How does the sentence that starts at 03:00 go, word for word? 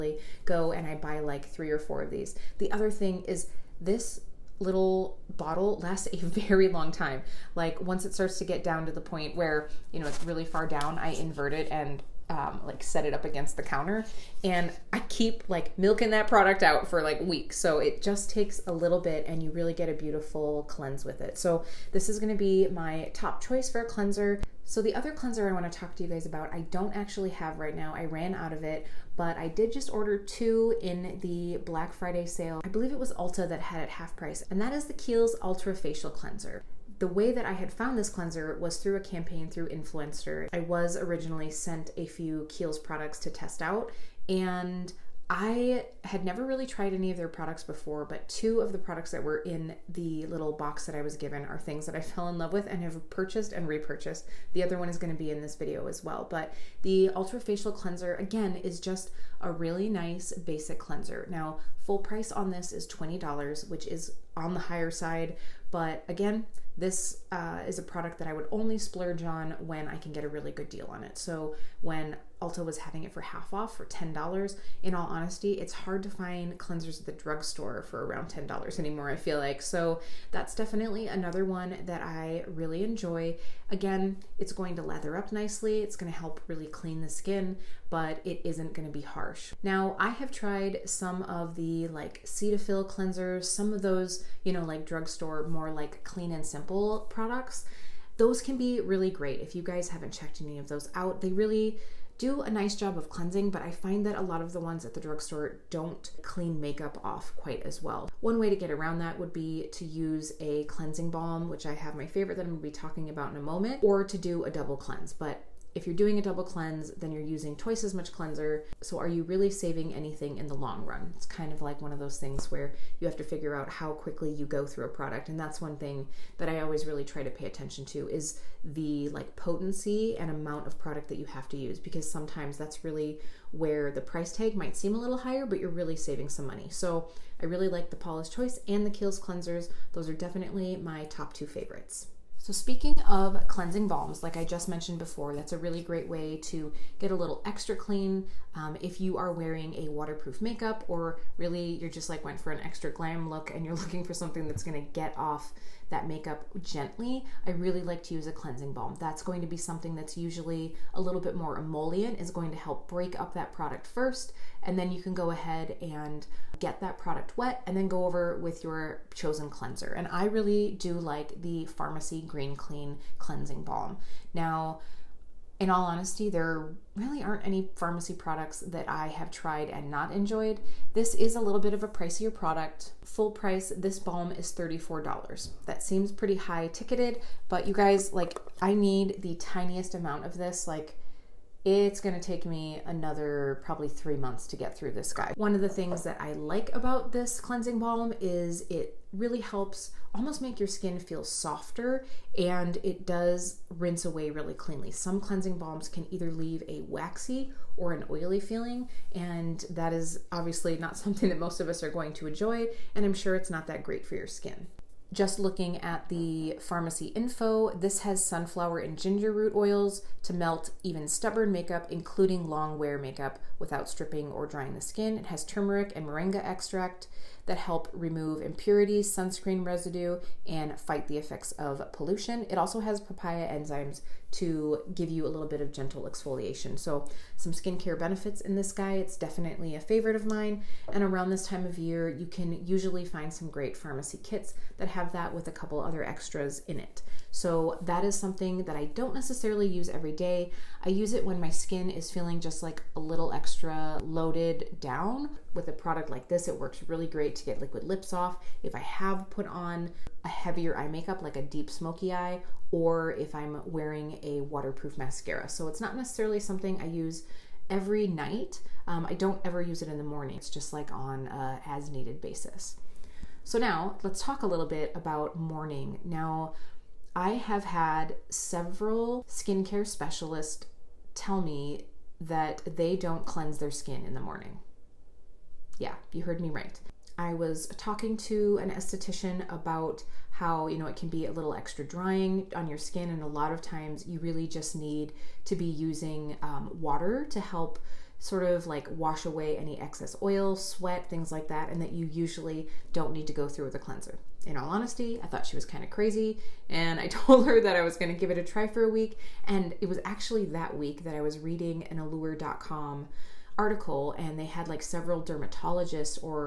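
This is a little bit of a pricier product.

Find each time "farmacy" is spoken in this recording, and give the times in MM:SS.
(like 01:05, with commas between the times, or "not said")
02:51, 02:57, 03:36, 04:03.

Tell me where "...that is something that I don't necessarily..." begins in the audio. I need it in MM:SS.
04:07.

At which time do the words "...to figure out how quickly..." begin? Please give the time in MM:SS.
02:03.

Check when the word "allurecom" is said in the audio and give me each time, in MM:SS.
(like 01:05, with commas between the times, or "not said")
05:11.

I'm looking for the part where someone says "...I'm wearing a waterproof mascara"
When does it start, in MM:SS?
04:23.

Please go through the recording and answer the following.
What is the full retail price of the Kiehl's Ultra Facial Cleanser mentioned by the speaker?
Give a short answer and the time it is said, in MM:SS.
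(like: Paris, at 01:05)
$20, at 01:02.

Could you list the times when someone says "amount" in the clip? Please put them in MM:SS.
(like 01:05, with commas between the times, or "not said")
02:10, 03:09.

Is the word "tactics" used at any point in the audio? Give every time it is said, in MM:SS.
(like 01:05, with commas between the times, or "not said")
not said.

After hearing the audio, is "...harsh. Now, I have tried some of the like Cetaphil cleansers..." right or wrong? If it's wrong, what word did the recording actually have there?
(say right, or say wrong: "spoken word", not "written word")
right.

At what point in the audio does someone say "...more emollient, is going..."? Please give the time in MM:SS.
02:41.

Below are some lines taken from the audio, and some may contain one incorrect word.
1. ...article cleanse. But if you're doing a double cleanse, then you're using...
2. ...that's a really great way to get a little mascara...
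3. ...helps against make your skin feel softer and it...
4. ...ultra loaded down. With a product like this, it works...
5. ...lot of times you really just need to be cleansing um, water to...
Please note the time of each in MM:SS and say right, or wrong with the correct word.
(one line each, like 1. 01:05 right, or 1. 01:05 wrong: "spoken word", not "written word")
1. 01:54 wrong: "double", not "article"
2. 02:25 wrong: "extra", not "mascara"
3. 03:19 wrong: "almost", not "against"
4. 04:13 wrong: "extra", not "ultra"
5. 04:53 wrong: "using", not "cleansing".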